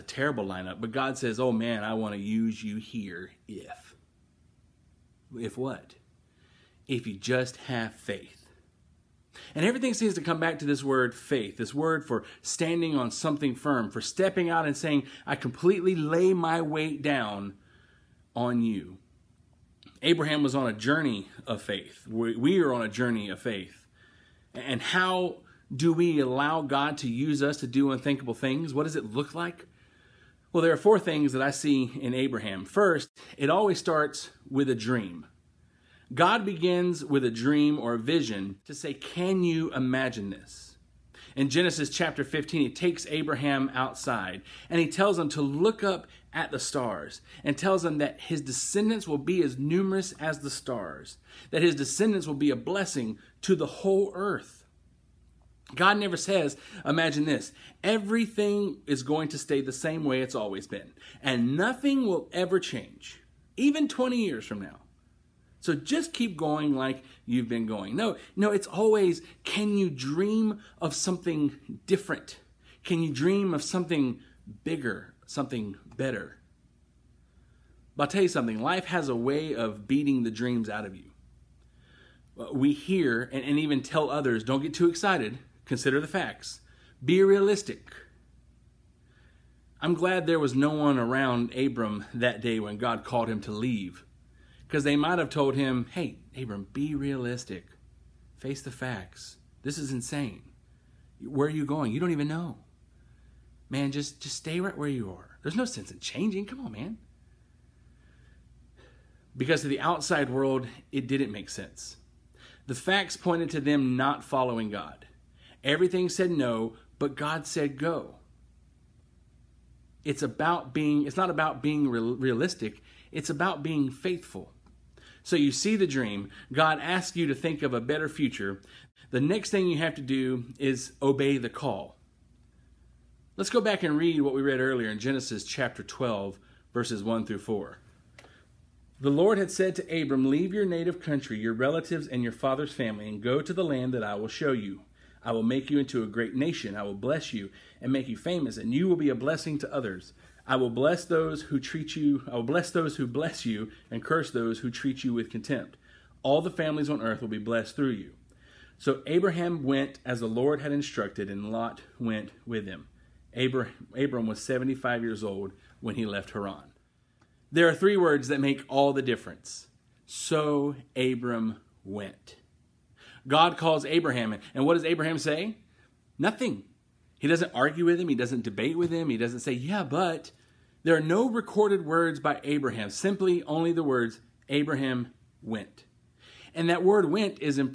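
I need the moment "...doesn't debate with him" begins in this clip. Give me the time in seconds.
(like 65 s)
178 s.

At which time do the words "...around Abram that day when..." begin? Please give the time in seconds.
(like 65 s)
90 s.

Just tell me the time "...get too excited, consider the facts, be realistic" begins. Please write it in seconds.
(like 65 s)
84 s.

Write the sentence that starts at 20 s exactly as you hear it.
Abraham was on a journey of faith.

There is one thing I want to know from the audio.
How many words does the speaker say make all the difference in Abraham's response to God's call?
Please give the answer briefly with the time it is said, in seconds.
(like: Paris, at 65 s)
3, at 167 s.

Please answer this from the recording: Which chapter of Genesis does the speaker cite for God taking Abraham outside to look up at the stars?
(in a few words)
Chapter 15.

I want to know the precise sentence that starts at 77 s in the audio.
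But I'll tell you something life has a way of beating the dreams out of you.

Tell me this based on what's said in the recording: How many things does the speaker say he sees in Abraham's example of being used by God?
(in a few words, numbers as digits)
4.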